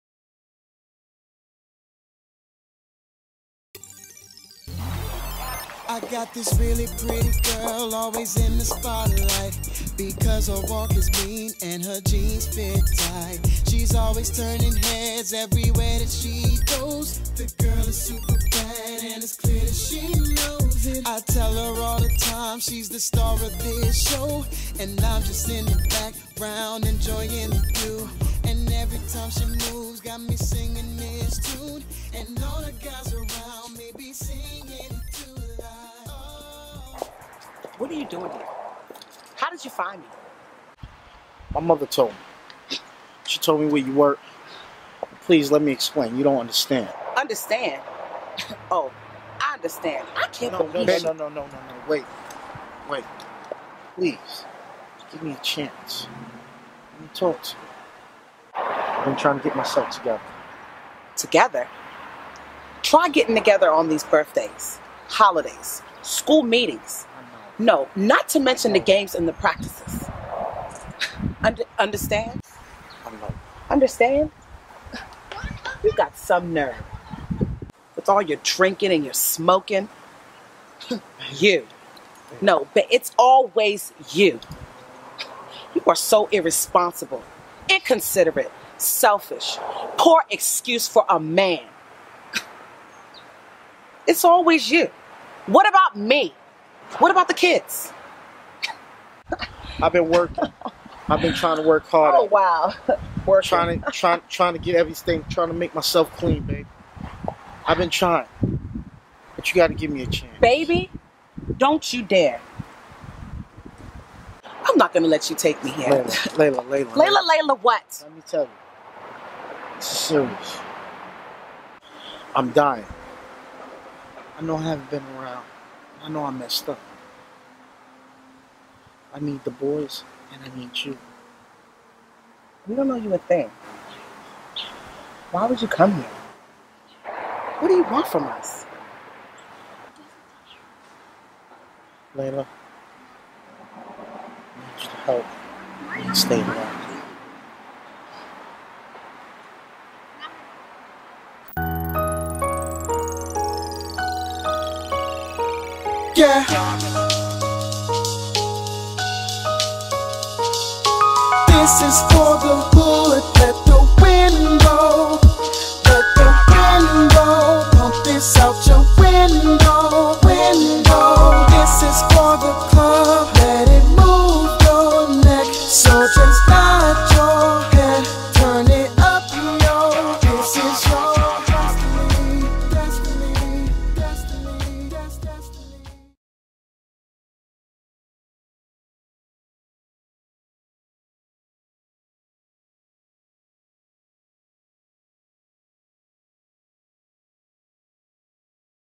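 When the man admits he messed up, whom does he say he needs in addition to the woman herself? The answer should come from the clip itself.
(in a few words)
The boys.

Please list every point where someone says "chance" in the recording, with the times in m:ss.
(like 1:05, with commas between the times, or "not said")
0:55, 1:50.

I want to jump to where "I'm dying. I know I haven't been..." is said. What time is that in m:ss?
2:02.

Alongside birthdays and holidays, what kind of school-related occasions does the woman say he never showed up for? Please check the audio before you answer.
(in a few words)
School meetings.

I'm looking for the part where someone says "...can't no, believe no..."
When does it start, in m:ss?
0:50.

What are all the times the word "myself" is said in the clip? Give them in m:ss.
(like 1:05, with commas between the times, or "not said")
0:59, 1:45.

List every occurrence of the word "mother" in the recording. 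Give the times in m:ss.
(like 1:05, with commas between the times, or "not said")
0:41.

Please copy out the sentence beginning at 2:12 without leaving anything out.
We don't know you a thing.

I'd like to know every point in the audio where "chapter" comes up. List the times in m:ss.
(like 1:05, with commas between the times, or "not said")
not said.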